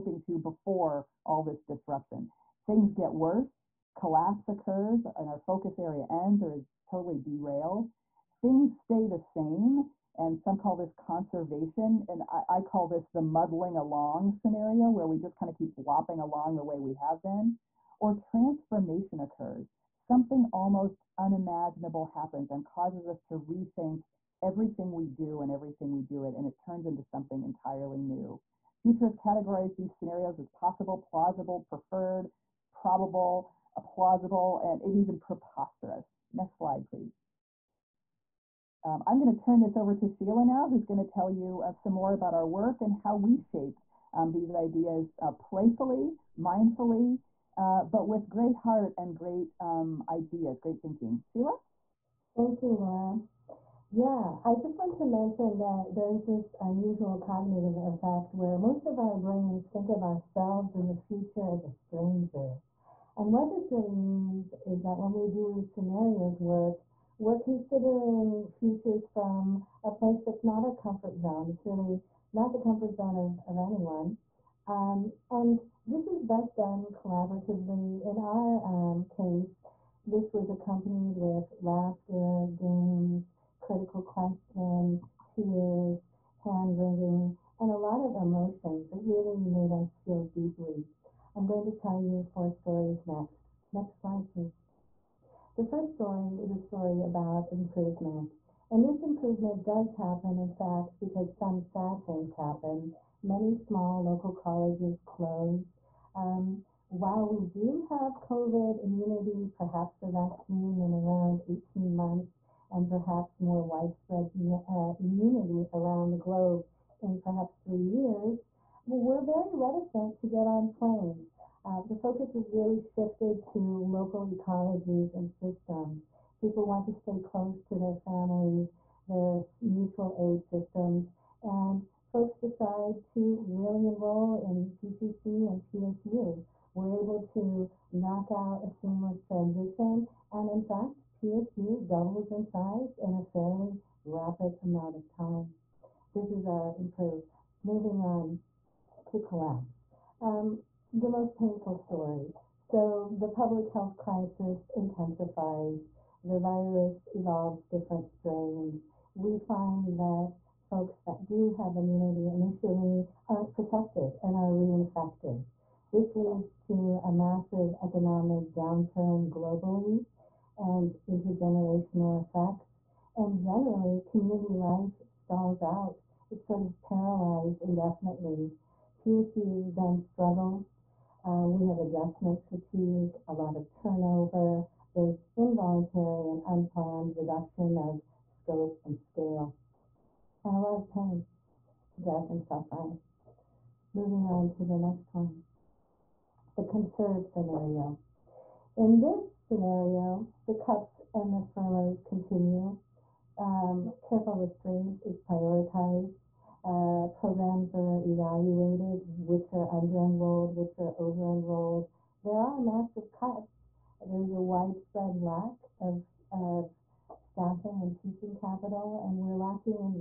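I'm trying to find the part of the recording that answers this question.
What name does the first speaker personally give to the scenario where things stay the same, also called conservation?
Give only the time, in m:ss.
0:13.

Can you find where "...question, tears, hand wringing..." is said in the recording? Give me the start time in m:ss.
1:24.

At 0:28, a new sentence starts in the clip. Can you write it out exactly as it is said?
Futurists categorize these scenarios as possible, plausible, preferred, probable, plausible, and, and even preposterous.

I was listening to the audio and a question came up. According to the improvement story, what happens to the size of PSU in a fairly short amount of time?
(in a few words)
Doubles in size.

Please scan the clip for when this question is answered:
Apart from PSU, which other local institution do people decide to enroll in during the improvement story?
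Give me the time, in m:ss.
2:14.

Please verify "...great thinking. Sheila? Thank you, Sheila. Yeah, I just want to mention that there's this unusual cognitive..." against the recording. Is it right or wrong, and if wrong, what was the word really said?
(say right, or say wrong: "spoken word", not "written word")
wrong: "Laura", not "Sheila".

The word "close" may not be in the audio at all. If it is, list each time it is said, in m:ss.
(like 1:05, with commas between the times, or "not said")
1:45, 2:07.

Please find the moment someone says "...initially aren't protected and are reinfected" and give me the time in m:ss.
2:42.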